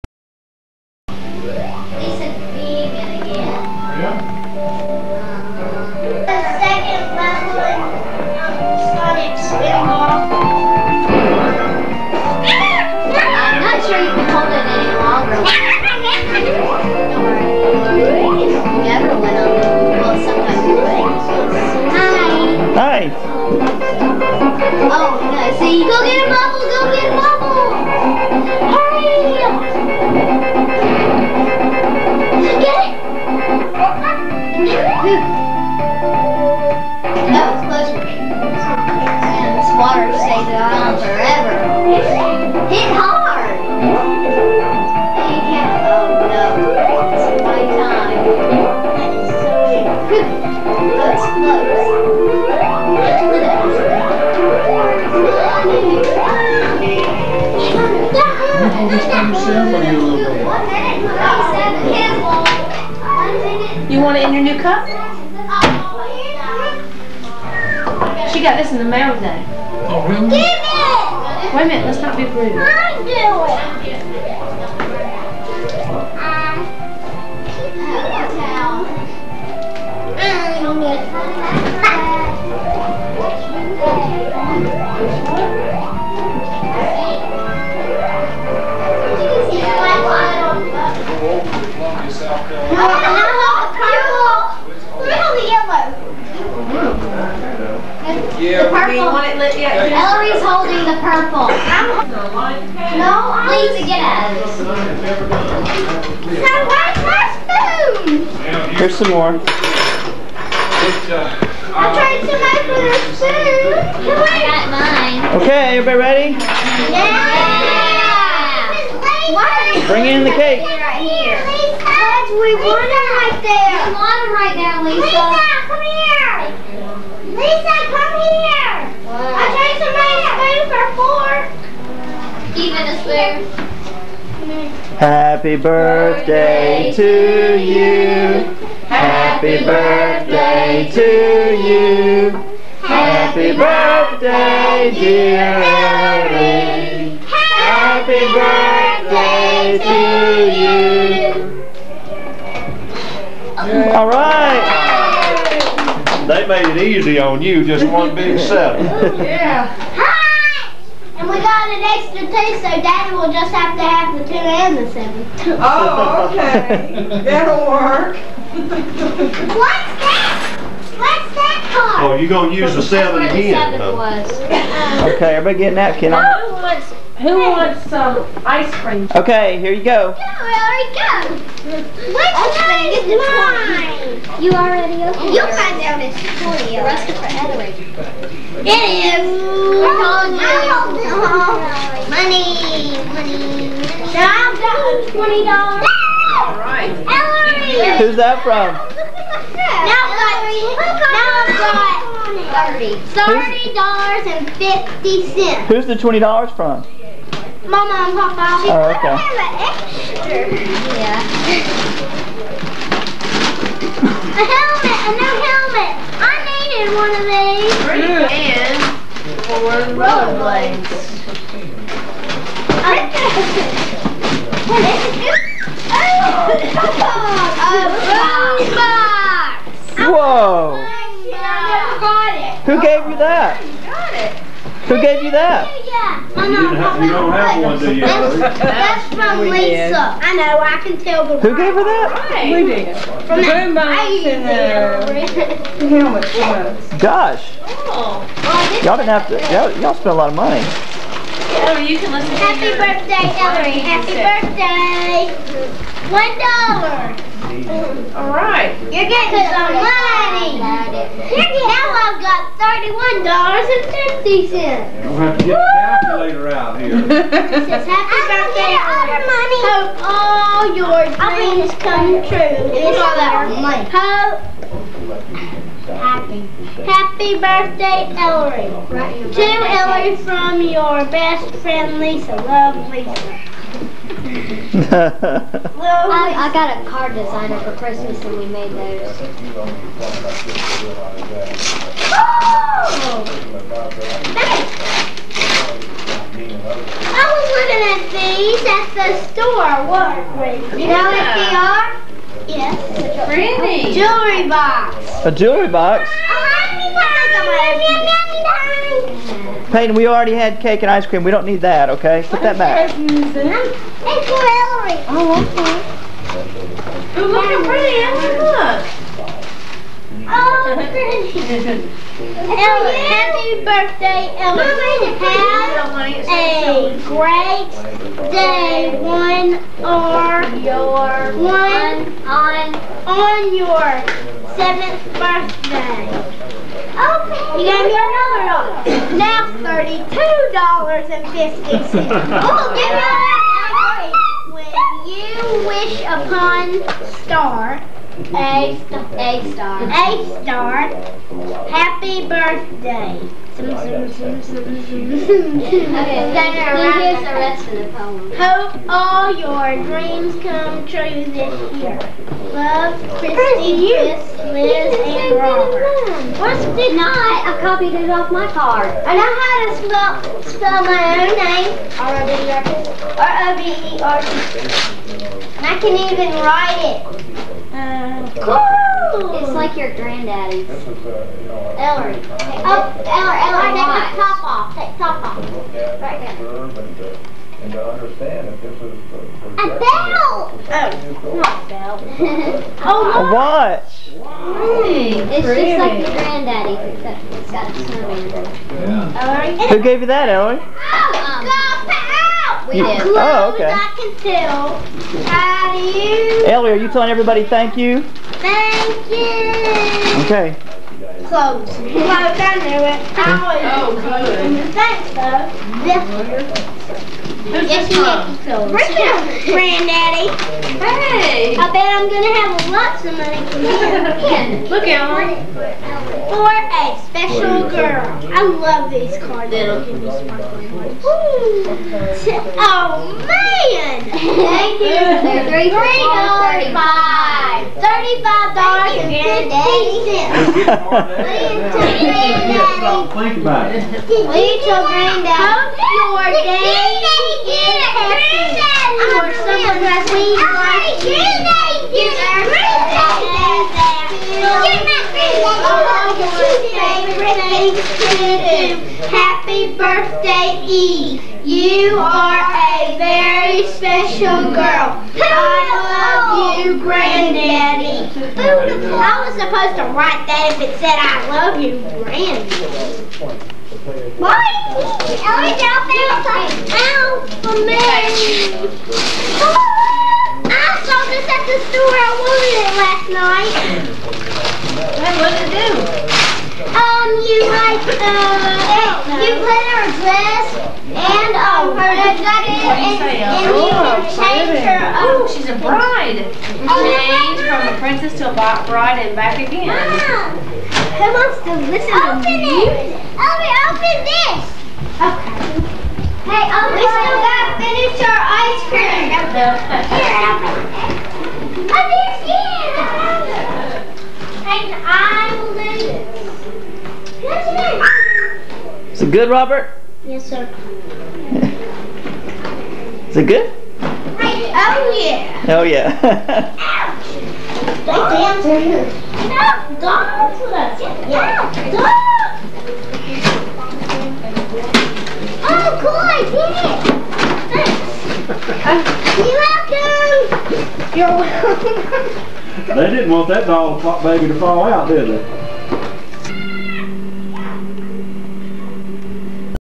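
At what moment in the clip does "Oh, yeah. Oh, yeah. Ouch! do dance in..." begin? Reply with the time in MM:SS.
08:43.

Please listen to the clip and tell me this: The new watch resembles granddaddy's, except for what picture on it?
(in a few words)
a snowman.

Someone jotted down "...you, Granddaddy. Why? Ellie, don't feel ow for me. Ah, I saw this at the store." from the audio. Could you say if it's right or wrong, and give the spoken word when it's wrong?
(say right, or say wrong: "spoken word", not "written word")
right.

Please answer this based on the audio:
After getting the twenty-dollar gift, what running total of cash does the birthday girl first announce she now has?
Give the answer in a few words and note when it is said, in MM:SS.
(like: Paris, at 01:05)
$30.50, at 03:23.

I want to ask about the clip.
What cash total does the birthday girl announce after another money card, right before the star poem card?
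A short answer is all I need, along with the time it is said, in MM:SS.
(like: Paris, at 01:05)
$32.50, at 05:39.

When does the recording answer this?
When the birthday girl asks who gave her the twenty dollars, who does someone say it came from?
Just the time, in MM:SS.
03:27.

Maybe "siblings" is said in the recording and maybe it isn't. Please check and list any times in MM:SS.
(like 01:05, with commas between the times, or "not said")
not said.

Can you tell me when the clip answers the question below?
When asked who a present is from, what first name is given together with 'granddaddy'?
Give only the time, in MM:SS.
06:58.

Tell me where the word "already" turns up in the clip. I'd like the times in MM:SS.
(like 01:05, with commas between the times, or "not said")
03:04, 05:10.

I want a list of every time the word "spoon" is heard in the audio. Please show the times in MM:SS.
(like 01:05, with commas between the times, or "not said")
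01:47, 01:53.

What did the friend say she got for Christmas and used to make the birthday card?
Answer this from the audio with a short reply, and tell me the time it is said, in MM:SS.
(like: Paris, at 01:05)
a card designer, at 04:46.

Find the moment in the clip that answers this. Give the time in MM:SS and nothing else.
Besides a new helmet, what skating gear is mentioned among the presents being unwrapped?
03:39.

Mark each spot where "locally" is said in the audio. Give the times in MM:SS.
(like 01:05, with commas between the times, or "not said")
not said.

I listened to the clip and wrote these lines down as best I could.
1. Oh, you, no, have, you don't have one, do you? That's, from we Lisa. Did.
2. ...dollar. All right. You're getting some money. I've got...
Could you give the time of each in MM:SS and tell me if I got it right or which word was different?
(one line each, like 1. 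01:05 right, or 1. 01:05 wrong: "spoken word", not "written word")
1. 03:56 right
2. 04:16 right.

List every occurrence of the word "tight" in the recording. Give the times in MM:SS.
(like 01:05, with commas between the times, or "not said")
not said.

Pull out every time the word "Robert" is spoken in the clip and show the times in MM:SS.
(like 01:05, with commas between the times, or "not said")
06:05, 08:39.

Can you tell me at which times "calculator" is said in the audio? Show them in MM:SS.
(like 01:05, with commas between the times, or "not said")
04:26.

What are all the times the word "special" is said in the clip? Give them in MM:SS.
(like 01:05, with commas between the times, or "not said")
07:07, 07:43.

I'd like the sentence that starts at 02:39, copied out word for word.
yeah an extra two, so Daddy will just have to have the two and the seven.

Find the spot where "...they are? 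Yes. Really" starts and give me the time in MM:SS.
05:01.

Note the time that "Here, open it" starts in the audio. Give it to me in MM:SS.
08:29.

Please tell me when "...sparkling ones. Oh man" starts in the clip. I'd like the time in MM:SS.
07:10.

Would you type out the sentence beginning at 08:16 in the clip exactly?
Change from a princess to a bride and back again.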